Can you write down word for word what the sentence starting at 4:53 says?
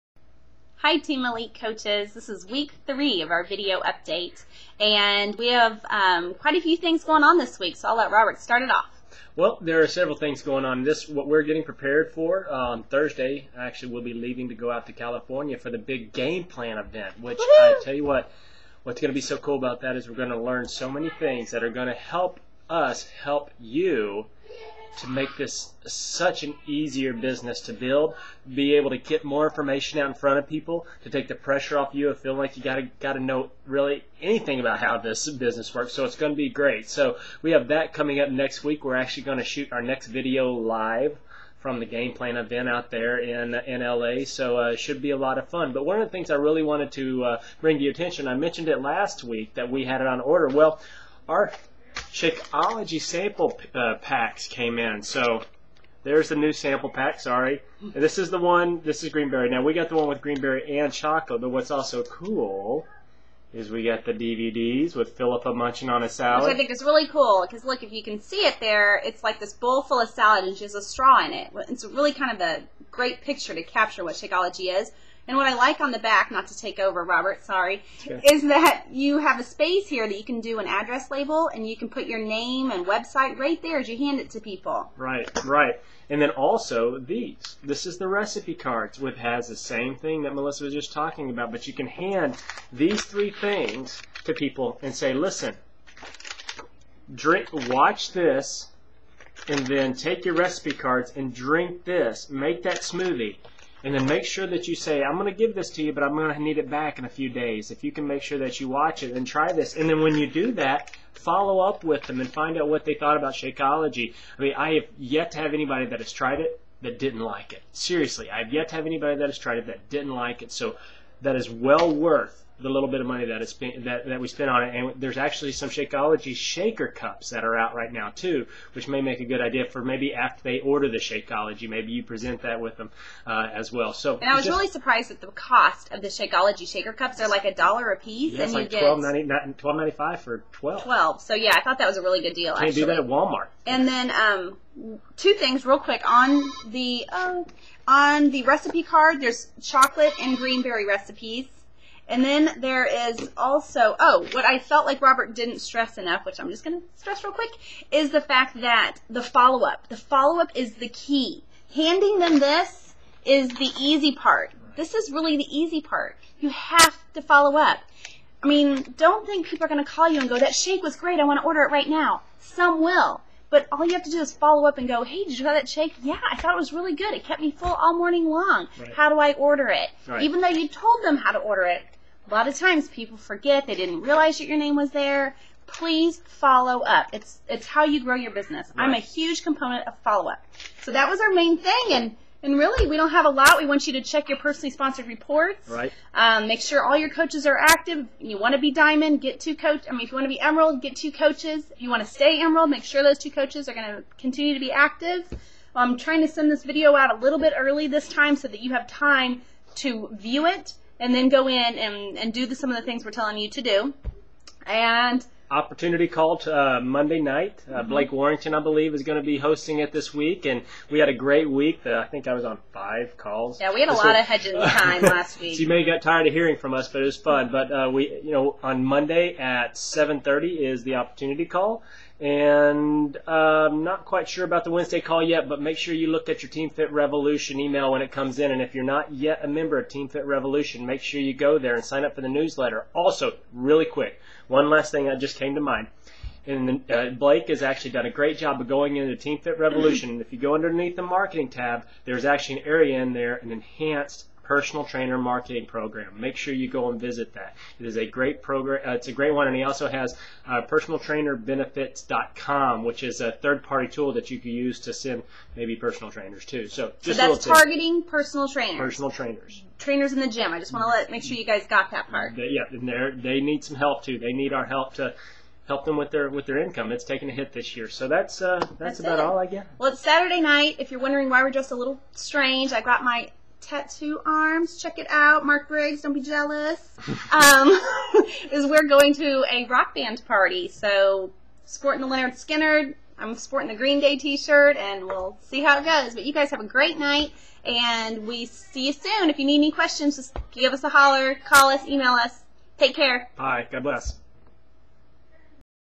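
I'm sporting the Green Day T-shirt, and we'll see how it goes.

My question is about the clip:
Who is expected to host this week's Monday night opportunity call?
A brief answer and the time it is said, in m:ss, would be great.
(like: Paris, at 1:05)
Blake Warrington, at 3:37.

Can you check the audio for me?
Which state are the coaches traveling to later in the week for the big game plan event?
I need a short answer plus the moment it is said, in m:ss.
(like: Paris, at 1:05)
California, at 0:14.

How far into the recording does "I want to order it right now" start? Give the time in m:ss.
2:51.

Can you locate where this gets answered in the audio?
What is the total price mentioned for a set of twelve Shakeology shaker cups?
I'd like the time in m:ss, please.
2:19.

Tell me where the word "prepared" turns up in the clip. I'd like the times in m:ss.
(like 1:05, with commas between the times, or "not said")
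0:11.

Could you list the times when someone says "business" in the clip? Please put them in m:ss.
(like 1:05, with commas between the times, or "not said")
0:27, 0:35, 3:08.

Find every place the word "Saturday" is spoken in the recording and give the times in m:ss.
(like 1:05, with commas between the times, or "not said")
4:40.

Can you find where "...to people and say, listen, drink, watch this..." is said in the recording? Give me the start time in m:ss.
1:34.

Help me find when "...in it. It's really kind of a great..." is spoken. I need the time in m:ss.
1:11.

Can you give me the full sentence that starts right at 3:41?
Uh, I think I was on five calls.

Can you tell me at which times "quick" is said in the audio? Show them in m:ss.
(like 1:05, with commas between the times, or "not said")
2:25, 2:37, 4:03.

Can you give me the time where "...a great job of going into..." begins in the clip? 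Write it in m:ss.
4:08.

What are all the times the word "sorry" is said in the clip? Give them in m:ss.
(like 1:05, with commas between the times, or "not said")
0:57, 1:17.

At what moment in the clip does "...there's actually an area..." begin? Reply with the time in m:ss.
4:12.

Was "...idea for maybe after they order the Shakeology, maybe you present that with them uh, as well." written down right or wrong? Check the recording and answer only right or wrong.
right.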